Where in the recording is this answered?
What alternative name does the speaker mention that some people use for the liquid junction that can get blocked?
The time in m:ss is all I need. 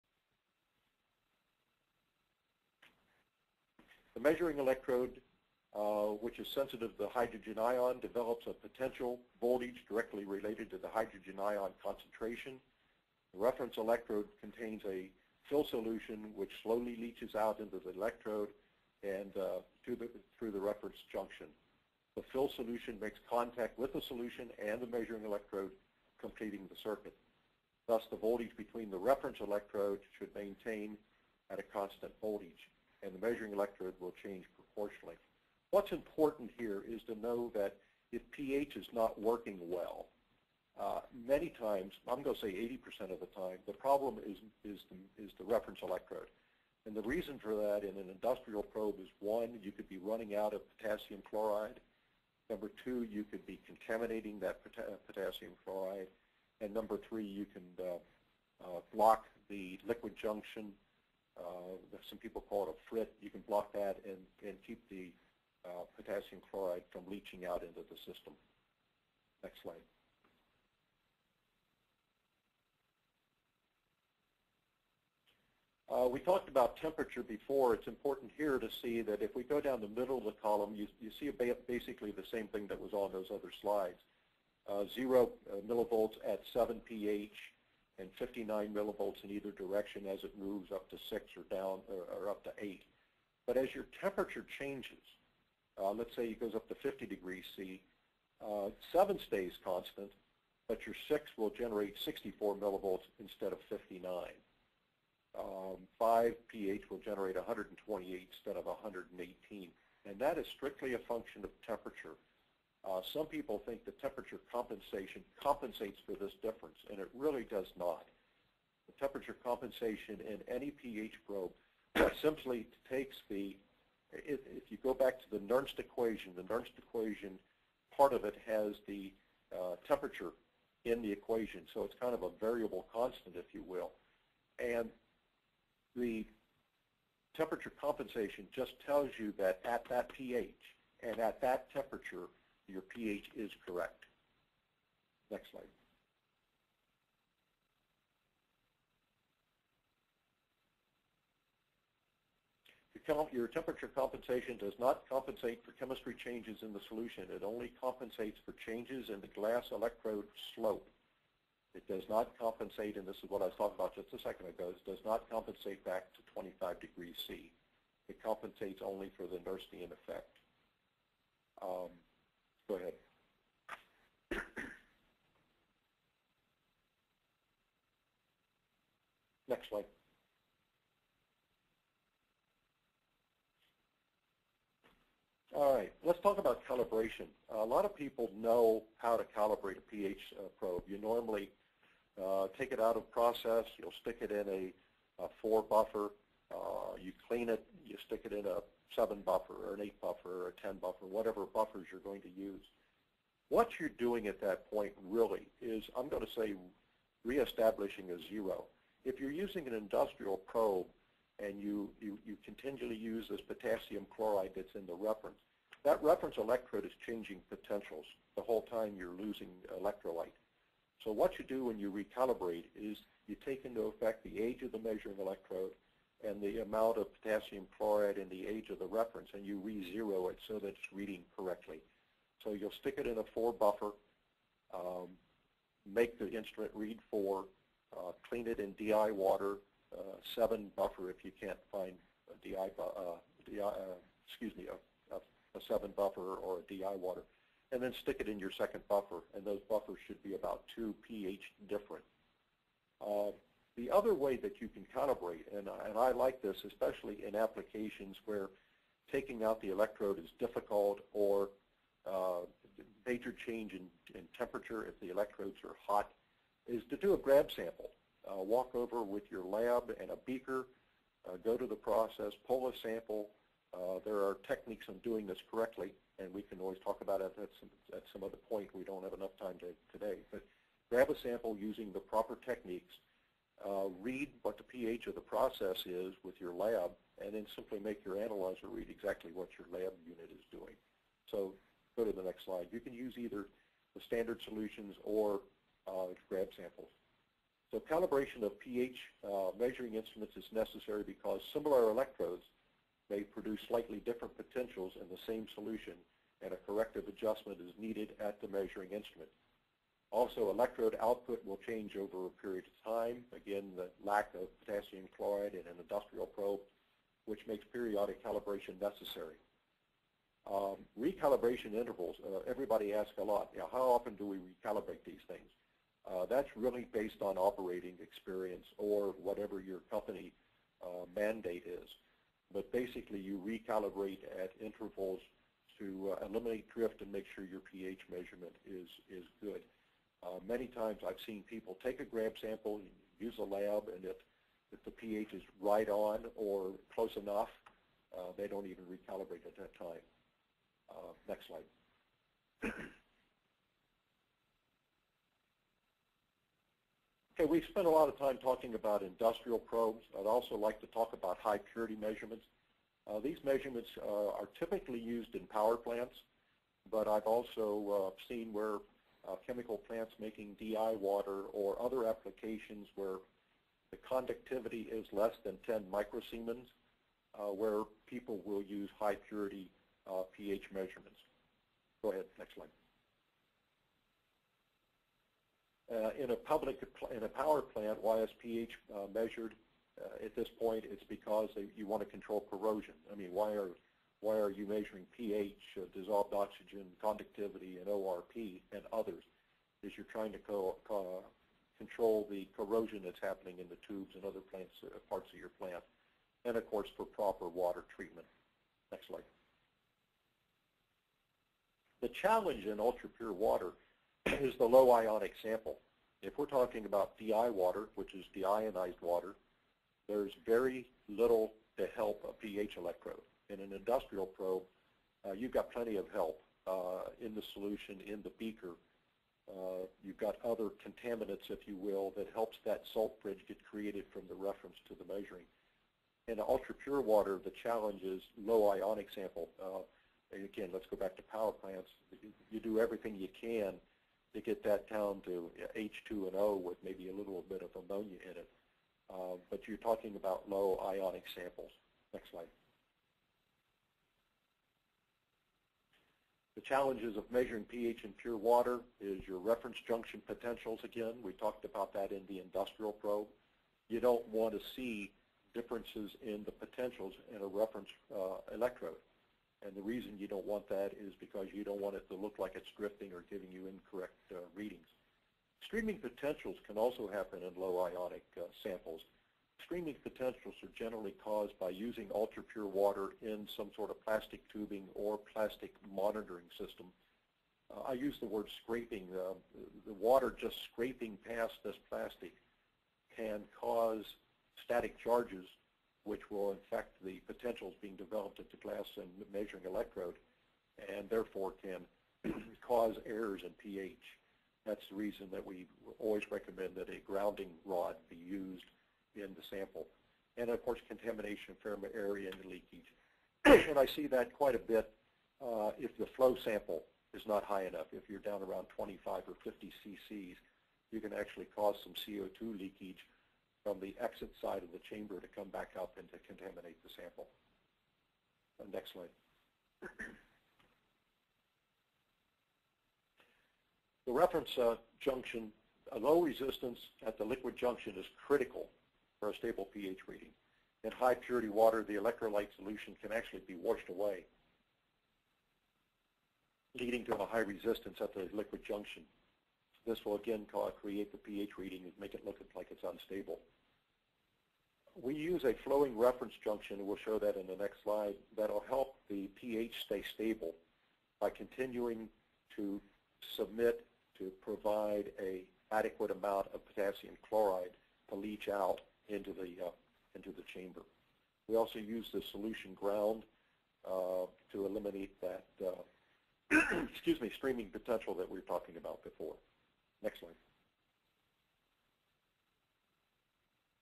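1:02.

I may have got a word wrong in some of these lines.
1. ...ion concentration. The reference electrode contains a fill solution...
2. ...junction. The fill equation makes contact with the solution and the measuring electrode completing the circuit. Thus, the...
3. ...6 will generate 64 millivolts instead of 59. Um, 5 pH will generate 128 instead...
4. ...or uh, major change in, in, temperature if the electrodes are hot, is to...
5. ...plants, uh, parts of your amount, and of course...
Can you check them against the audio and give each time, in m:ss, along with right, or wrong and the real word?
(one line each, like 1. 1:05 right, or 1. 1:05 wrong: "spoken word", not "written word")
1. 0:11 right
2. 0:21 wrong: "solution", not "equation"
3. 1:41 right
4. 4:21 right
5. 6:44 wrong: "plant", not "amount".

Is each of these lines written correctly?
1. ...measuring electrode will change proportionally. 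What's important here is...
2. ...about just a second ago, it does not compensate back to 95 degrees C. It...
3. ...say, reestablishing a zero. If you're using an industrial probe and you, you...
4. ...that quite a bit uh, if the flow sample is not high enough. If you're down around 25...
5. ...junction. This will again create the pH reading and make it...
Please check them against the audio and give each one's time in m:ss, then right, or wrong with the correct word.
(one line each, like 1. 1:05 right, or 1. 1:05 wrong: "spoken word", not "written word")
1. 0:33 right
2. 2:43 wrong: "25", not "95"
3. 3:26 right
4. 8:34 right
5. 9:08 right.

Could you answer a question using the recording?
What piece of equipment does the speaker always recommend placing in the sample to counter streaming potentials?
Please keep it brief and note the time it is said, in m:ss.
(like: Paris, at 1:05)
grounding rod, at 8:27.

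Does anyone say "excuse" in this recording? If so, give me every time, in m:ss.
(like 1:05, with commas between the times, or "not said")
4:04, 9:36.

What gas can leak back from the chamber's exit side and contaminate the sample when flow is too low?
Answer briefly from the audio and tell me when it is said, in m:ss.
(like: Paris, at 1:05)
CO2, at 8:41.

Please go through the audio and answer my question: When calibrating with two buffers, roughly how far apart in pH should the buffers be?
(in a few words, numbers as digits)
2 pH.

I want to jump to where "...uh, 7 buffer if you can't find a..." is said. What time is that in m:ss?
3:59.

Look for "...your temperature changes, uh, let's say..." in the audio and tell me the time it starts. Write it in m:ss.
1:33.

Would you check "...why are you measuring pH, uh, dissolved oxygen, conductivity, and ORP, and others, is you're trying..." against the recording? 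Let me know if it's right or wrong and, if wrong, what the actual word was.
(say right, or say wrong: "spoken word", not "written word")
right.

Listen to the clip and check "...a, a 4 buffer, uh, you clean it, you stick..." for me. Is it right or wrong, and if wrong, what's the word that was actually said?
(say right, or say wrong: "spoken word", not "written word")
right.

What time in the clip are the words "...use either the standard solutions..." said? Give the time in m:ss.
4:52.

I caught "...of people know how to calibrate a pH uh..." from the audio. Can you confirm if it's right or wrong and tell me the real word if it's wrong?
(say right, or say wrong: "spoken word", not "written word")
right.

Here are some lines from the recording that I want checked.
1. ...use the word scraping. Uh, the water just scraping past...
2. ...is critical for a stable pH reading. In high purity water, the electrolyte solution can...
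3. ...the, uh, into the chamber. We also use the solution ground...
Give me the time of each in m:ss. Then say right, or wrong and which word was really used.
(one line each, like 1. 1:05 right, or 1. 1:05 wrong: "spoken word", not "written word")
1. 8:07 right
2. 8:57 right
3. 9:29 right.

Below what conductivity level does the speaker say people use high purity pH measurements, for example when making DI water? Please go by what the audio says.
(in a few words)
10 microsiemens.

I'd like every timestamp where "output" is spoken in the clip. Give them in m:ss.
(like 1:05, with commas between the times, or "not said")
5:11.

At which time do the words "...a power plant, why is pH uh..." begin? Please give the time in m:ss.
6:27.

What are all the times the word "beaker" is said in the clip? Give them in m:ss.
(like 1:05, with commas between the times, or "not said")
4:30, 7:08.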